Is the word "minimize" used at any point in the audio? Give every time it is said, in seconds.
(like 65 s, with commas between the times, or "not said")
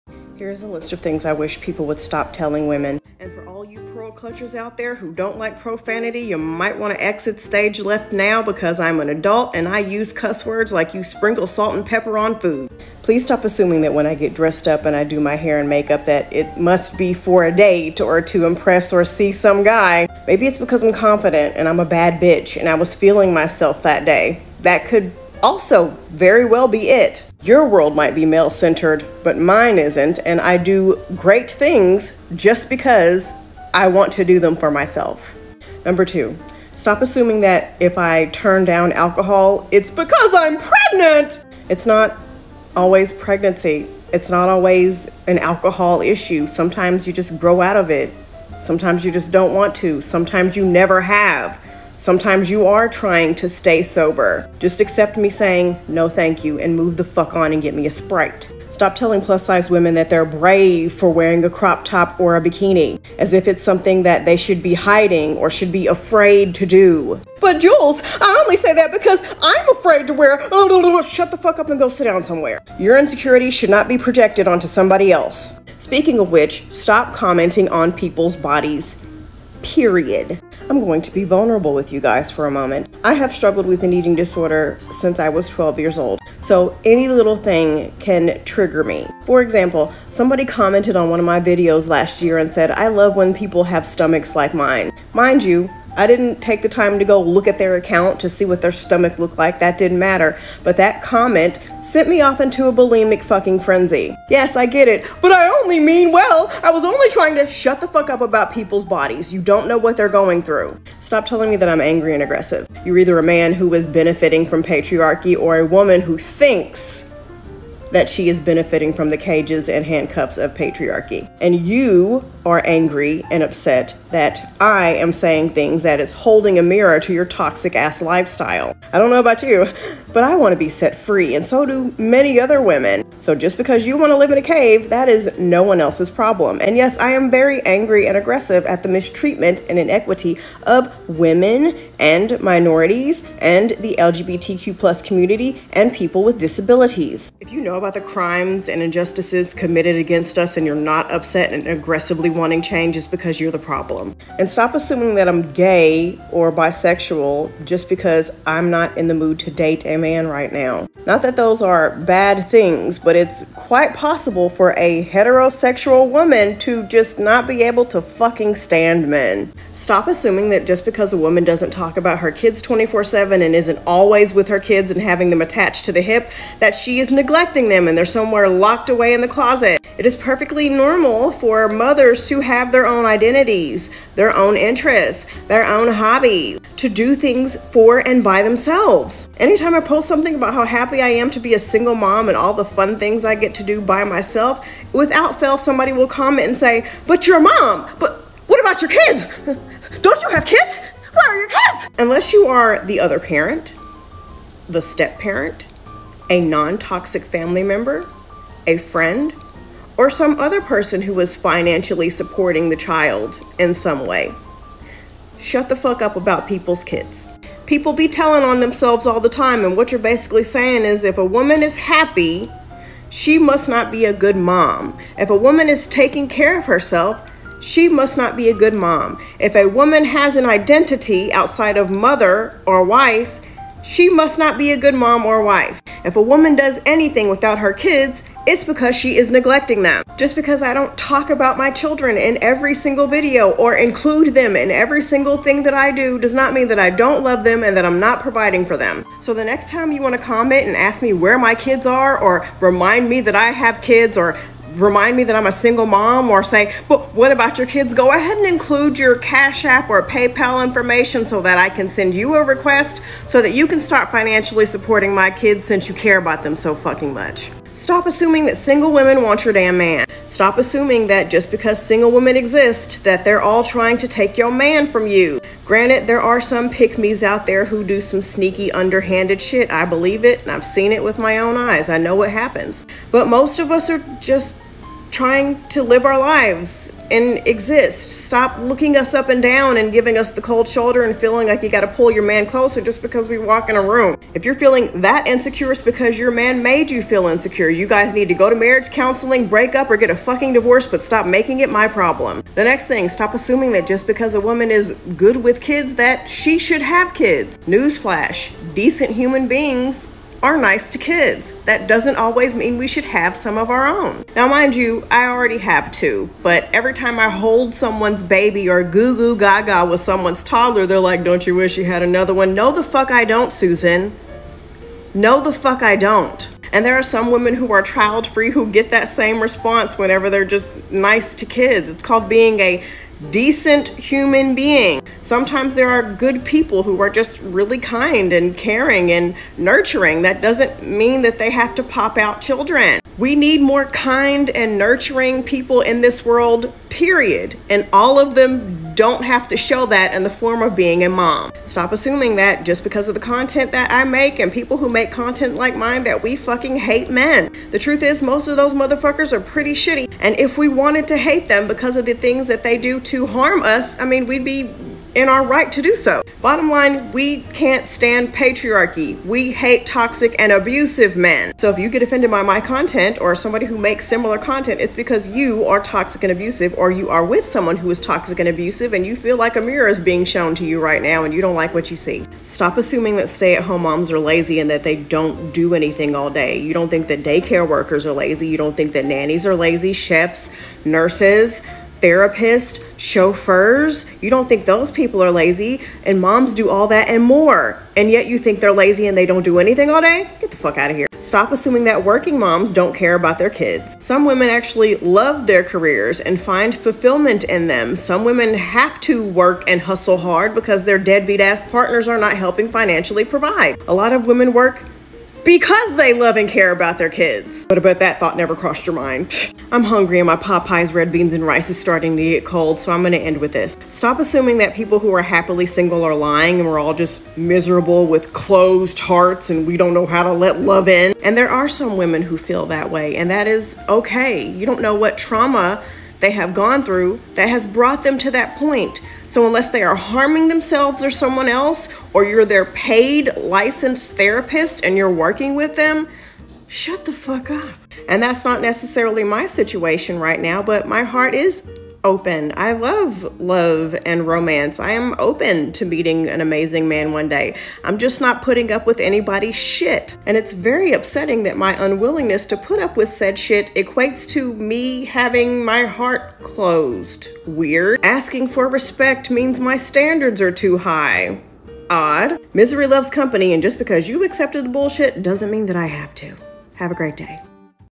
not said.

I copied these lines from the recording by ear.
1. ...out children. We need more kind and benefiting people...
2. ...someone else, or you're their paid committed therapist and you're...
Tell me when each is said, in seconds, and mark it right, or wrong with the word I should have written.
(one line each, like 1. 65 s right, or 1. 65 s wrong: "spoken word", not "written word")
1. 342 s wrong: "nurturing", not "benefiting"
2. 441 s wrong: "licensed", not "committed".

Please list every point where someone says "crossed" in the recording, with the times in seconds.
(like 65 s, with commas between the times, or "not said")
418 s.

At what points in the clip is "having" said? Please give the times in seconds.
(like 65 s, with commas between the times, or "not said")
175 s, 465 s.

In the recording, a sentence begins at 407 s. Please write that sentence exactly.
Some women have to work and hustle hard because their deadbeat ass partners are not helping financially provide.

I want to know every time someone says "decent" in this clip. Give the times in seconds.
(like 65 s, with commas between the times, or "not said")
308 s, 333 s.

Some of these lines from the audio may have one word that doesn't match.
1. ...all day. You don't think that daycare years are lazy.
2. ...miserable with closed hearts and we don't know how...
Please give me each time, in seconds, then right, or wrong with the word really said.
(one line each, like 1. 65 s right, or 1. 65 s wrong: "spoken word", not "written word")
1. 386 s wrong: "workers", not "years"
2. 427 s right.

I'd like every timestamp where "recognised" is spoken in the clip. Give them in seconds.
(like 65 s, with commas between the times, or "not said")
not said.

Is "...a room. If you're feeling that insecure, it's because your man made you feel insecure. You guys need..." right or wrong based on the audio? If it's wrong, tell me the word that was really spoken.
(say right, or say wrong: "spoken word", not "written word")
right.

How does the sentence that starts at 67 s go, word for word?
But Joules, I only say that because I'm afraid to wear.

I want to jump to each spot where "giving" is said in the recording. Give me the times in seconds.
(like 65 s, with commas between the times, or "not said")
289 s.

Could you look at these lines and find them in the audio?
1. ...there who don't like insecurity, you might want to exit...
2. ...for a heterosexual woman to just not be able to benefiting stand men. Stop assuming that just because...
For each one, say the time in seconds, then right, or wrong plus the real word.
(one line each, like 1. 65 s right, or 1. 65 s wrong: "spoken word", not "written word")
1. 4 s wrong: "profanity", not "insecurity"
2. 164 s wrong: "fucking", not "benefiting".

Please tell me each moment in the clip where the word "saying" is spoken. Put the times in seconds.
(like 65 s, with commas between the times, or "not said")
55 s, 125 s, 220 s.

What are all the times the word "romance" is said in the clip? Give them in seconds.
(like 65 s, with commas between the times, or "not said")
454 s.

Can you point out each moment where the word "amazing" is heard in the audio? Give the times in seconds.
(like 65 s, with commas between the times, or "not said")
456 s.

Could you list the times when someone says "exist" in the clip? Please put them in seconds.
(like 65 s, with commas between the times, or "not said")
272 s, 287 s.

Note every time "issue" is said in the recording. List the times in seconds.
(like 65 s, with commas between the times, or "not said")
46 s.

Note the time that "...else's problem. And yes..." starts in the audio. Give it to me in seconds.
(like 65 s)
135 s.